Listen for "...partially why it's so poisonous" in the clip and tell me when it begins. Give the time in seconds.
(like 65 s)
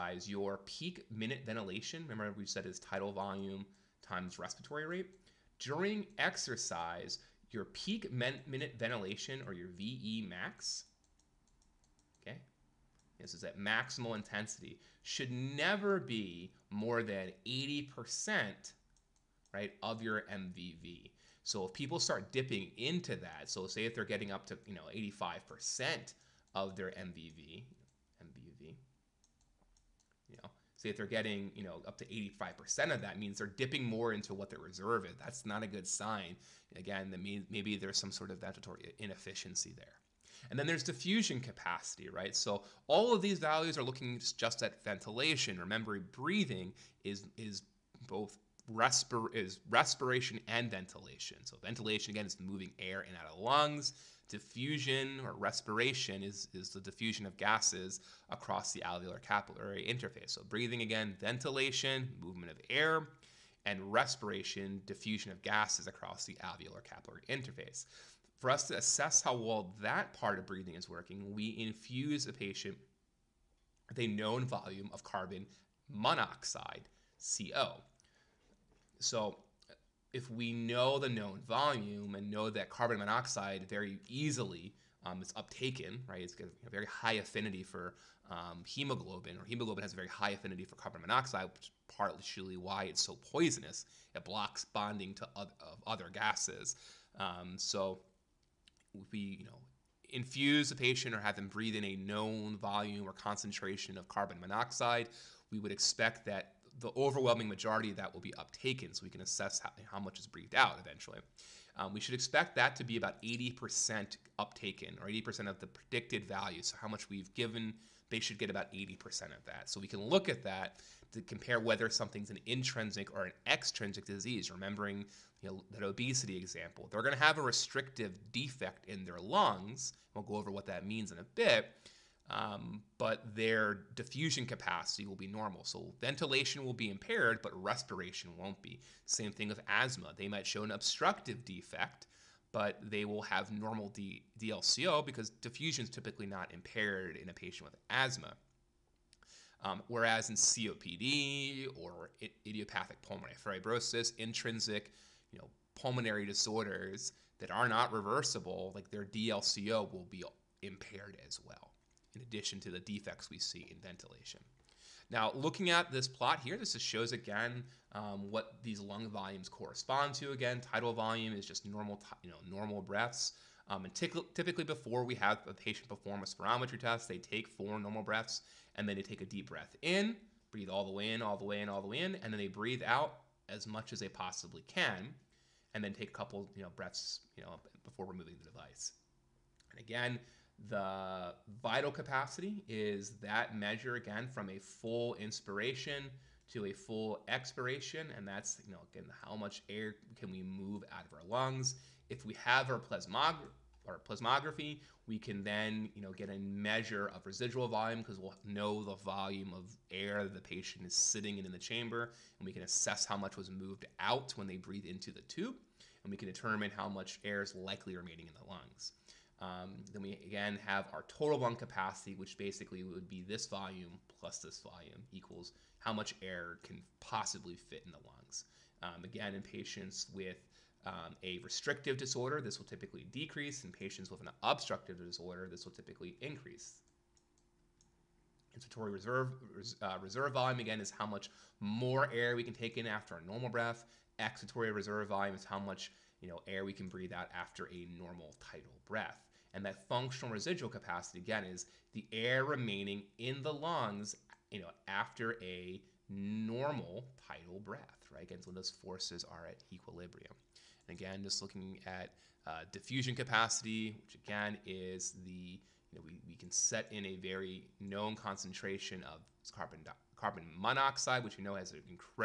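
91 s.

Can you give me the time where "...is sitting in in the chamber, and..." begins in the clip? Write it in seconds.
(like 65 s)
210 s.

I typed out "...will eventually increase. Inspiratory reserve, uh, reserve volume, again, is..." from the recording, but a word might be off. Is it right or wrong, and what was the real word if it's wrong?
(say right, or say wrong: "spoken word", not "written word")
wrong: "typically", not "eventually".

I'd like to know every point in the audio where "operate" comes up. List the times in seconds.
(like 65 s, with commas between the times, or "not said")
not said.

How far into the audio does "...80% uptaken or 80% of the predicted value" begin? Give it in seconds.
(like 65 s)
113 s.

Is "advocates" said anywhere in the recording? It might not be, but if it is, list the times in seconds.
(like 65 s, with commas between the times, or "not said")
not said.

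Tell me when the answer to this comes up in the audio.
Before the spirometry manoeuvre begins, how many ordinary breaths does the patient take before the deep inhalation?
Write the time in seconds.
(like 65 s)
177 s.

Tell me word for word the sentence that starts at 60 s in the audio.
So breathing again, ventilation, movement of air, and respiration, diffusion of gases across the alveolar capillary interface.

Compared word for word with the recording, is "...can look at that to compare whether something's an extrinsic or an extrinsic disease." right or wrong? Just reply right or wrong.
wrong.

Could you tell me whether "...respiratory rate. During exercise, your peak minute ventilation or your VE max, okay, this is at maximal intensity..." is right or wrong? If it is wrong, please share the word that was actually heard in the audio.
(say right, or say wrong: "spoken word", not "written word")
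right.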